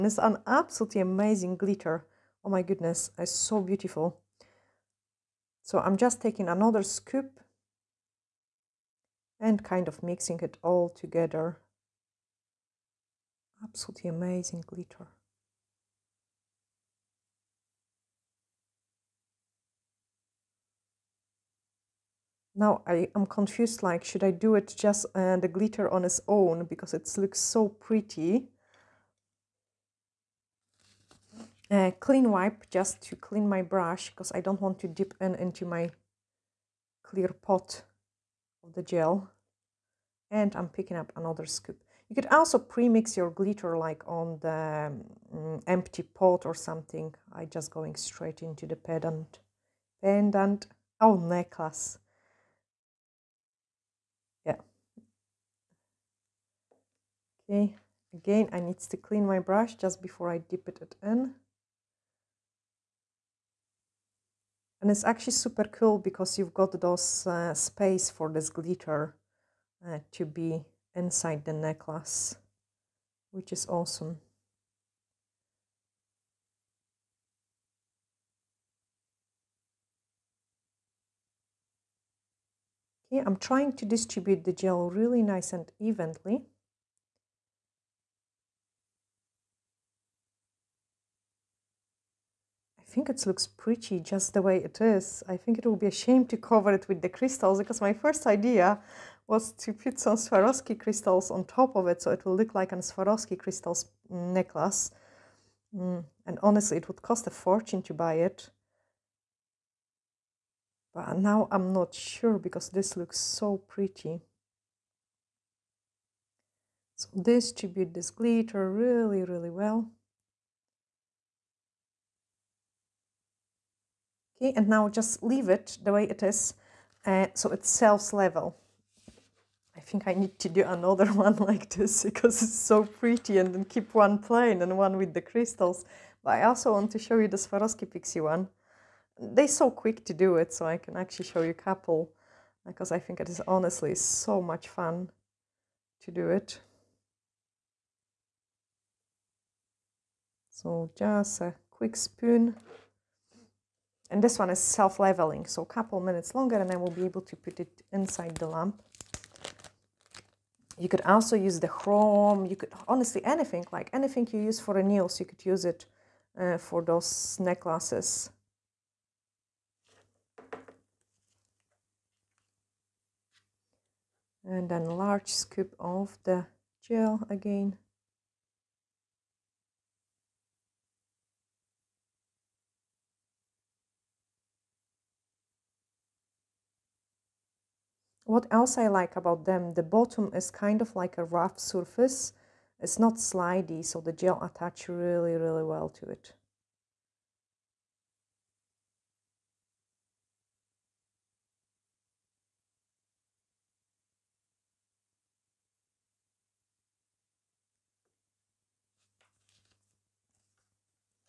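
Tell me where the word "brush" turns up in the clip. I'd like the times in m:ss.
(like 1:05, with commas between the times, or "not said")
0:33, 0:59.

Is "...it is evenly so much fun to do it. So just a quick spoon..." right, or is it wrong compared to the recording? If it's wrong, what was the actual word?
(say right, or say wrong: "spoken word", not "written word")
wrong: "honestly", not "evenly".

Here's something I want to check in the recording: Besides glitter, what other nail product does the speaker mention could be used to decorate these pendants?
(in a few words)
Chrome.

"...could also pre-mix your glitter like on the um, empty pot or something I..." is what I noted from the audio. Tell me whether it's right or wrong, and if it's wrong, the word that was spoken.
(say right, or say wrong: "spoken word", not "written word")
right.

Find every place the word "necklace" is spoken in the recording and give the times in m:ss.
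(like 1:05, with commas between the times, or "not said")
0:51, 1:11, 1:44, 2:47.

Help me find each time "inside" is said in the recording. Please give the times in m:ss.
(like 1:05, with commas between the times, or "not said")
1:10, 2:37.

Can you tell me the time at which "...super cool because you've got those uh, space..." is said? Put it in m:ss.
1:05.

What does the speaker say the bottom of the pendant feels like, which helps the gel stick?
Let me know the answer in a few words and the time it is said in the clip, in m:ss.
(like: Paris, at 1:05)
A rough surface, at 3:11.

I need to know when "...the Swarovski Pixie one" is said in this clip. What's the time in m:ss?
2:17.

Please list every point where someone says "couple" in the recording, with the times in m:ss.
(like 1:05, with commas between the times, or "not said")
2:21, 2:35.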